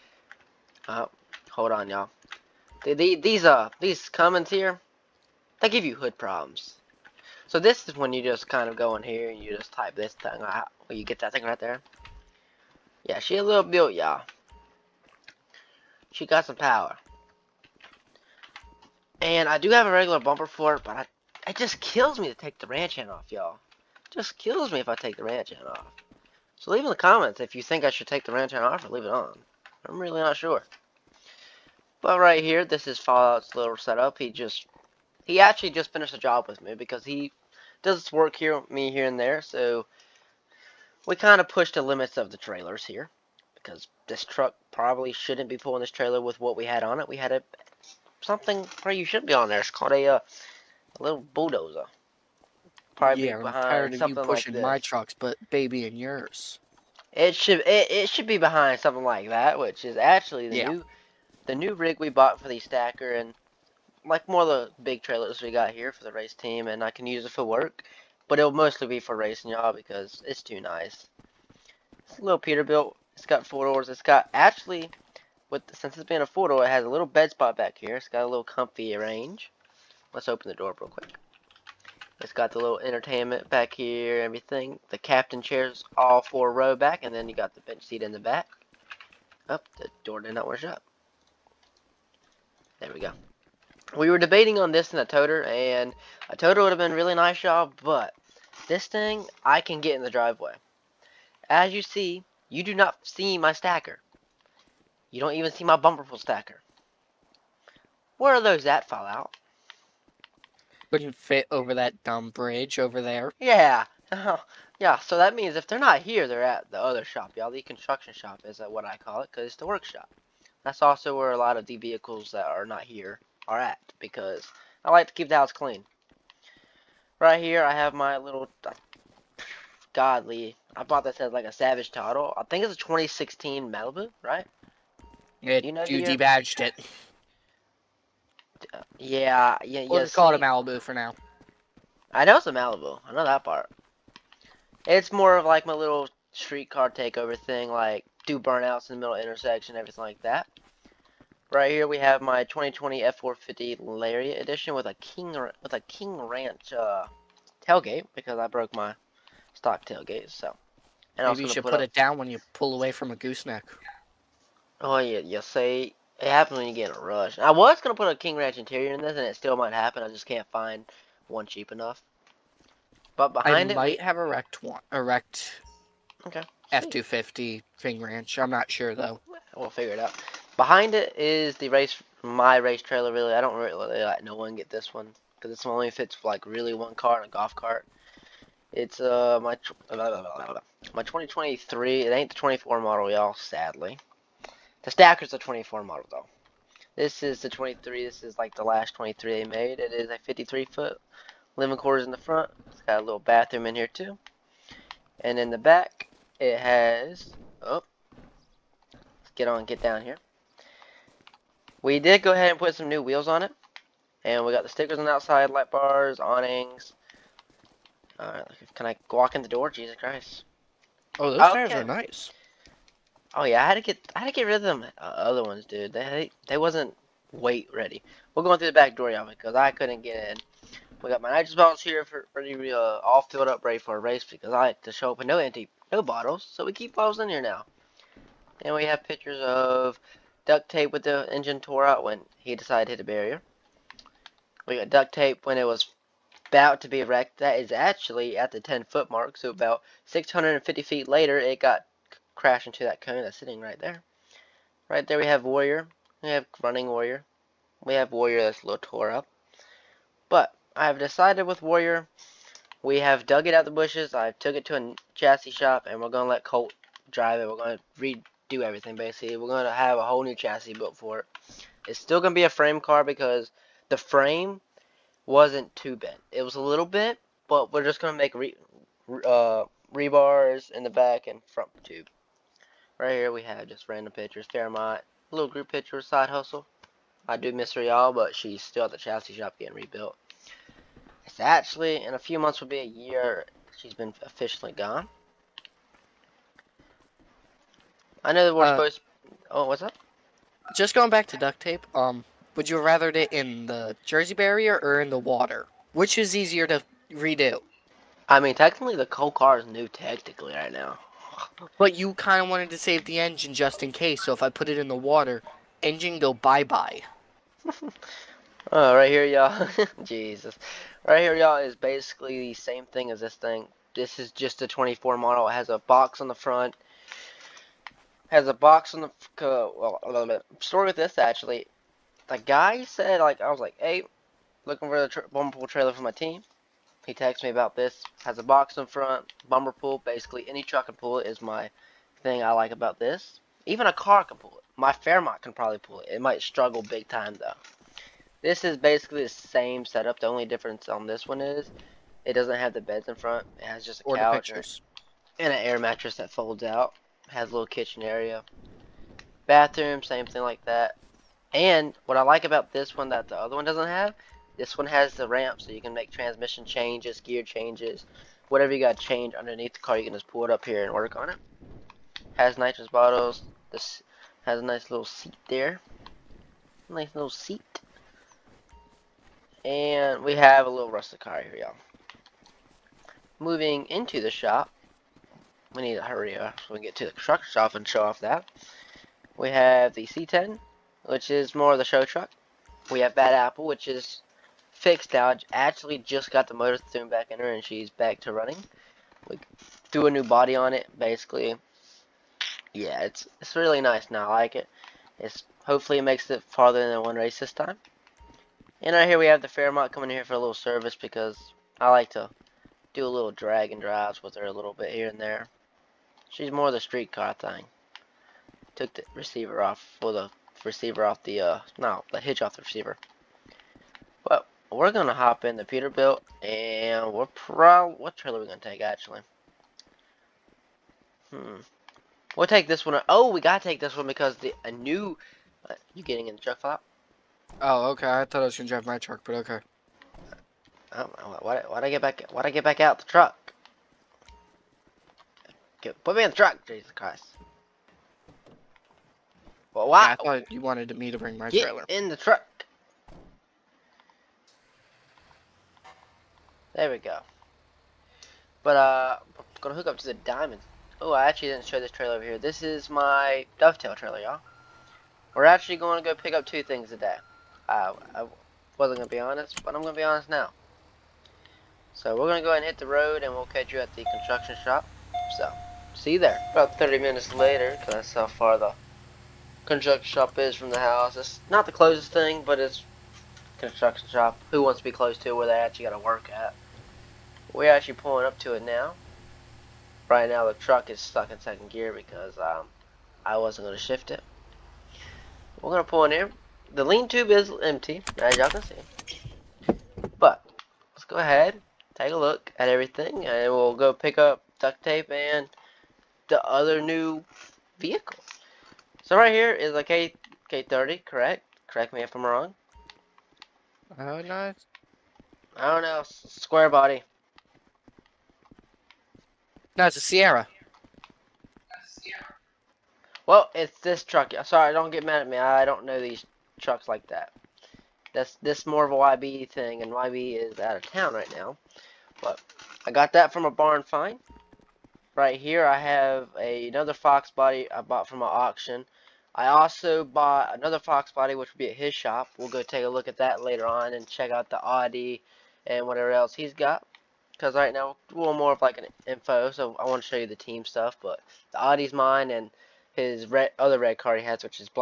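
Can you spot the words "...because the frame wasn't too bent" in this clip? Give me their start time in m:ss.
4:33.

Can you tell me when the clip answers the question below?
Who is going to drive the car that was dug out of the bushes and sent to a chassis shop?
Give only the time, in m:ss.
4:26.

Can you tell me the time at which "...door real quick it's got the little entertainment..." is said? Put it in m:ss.
1:20.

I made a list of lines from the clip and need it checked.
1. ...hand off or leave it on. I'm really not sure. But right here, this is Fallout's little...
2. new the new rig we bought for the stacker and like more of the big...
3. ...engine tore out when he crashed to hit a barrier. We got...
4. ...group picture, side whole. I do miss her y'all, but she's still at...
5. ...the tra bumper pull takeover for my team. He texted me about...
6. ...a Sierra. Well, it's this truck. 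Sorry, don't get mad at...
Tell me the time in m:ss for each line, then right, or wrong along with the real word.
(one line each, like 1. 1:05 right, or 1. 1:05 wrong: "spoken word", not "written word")
1. 0:28 right
2. 1:00 right
3. 4:01 wrong: "decided", not "crashed"
4. 4:45 wrong: "hustle", not "whole"
5. 5:35 wrong: "trailer", not "takeover"
6. 8:39 right.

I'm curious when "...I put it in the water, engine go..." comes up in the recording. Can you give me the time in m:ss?
5:14.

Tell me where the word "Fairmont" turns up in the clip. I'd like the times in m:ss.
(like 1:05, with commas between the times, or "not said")
4:44, 5:44, 6:49.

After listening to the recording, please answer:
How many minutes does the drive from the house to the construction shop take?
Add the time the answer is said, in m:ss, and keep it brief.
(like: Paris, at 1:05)
30, at 7:56.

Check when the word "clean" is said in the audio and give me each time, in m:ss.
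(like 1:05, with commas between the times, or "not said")
2:05.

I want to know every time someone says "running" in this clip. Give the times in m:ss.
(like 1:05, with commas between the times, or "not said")
4:16, 6:38.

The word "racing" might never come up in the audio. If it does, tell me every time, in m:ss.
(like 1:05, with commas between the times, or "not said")
1:09.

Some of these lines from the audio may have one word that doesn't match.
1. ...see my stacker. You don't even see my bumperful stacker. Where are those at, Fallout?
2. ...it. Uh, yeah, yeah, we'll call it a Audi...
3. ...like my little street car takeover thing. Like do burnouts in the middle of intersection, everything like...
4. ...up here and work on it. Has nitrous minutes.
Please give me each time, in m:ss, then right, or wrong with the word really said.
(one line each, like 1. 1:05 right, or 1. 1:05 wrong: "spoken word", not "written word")
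1. 1:43 right
2. 2:16 wrong: "Malibu", not "Audi"
3. 2:25 right
4. 6:10 wrong: "bottles", not "minutes".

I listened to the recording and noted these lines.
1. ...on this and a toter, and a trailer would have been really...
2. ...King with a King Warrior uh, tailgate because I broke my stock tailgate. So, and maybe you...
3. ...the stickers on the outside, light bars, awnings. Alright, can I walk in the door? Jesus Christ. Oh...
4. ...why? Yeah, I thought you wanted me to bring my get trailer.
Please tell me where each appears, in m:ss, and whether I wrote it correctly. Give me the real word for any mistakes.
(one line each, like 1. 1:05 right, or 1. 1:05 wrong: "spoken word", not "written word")
1. 1:34 wrong: "toter", not "trailer"
2. 2:35 wrong: "Ranch", not "Warrior"
3. 3:34 right
4. 7:29 right.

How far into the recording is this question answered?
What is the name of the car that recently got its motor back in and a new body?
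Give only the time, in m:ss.
6:33.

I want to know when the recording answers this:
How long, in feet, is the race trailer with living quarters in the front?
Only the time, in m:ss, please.
3:20.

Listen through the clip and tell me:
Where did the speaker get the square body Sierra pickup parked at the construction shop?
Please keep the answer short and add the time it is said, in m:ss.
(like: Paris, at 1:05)
a barn find, at 8:53.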